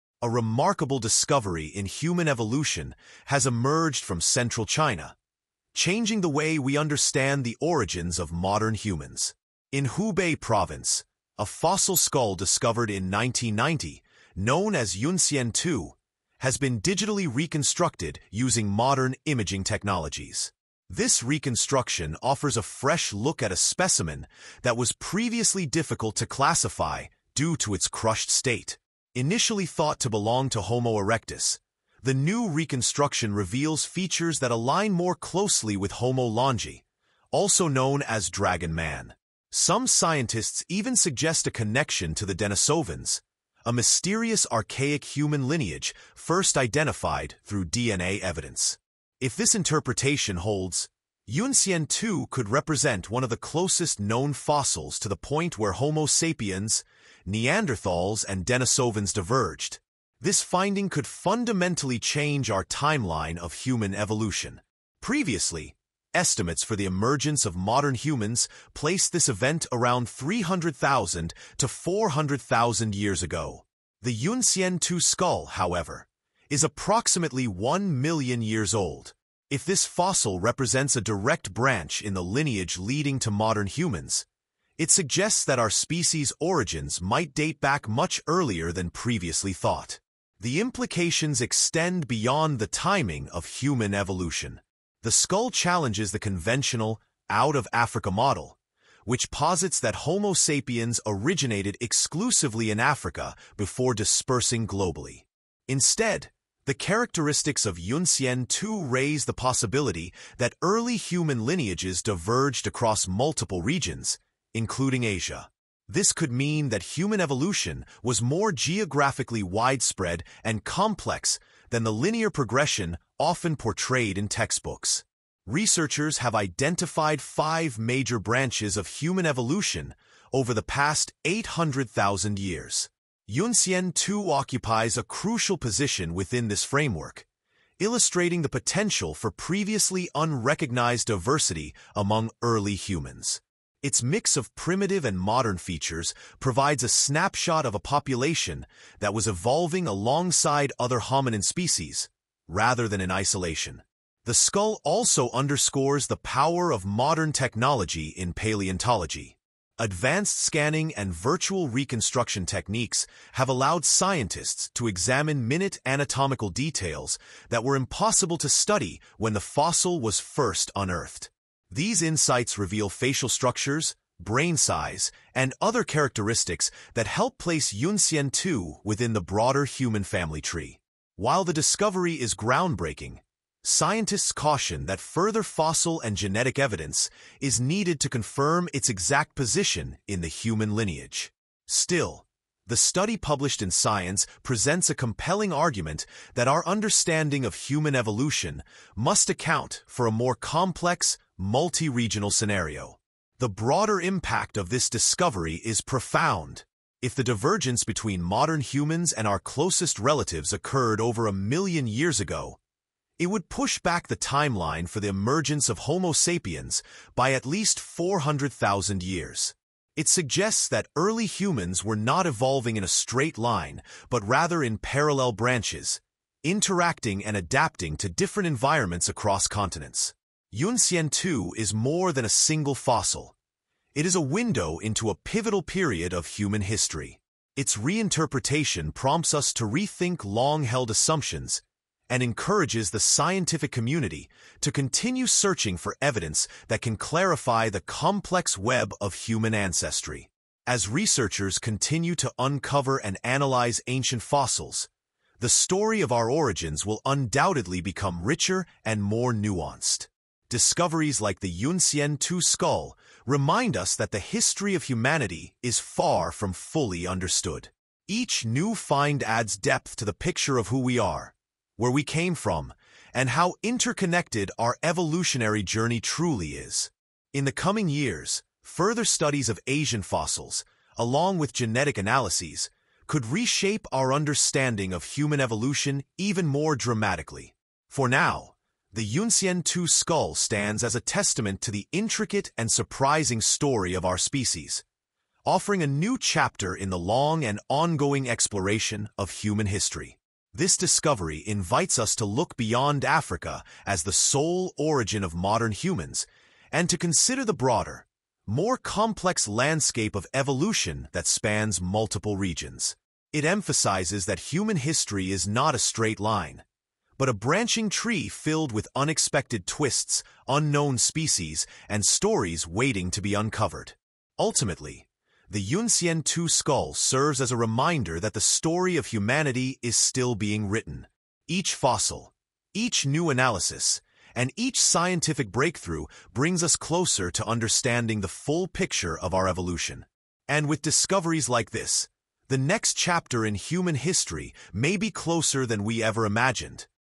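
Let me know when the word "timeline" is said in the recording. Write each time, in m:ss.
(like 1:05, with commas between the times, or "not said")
1:02, 3:34.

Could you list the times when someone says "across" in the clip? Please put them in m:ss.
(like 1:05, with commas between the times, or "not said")
1:52, 3:49.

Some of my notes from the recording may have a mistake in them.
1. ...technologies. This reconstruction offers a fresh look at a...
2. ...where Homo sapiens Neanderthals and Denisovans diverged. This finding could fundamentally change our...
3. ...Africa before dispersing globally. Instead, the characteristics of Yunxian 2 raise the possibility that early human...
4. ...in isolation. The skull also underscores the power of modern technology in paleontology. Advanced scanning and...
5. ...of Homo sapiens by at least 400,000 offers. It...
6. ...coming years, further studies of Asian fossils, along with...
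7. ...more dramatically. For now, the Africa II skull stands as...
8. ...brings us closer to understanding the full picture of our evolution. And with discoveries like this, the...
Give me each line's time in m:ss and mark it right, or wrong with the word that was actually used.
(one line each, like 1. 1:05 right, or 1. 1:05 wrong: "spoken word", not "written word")
1. 0:19 right
2. 0:55 right
3. 1:42 right
4. 2:33 right
5. 3:35 wrong: "years", not "offers"
6. 4:37 right
7. 4:46 wrong: "Yunxian", not "Africa"
8. 5:36 right.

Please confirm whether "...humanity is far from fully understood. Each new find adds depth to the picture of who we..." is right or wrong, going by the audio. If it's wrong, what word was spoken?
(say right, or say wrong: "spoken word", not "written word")
right.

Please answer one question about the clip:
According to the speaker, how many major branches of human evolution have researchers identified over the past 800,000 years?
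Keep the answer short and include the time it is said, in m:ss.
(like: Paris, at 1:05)
5, at 2:07.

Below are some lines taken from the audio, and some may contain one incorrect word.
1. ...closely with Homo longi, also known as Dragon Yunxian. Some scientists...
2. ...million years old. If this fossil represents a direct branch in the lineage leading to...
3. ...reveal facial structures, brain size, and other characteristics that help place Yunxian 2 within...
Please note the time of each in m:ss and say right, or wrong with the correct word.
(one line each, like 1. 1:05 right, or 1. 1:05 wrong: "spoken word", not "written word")
1. 0:35 wrong: "Man", not "Yunxian"
2. 1:18 right
3. 2:52 right.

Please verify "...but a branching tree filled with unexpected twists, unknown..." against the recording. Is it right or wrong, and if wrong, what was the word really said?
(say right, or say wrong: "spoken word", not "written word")
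right.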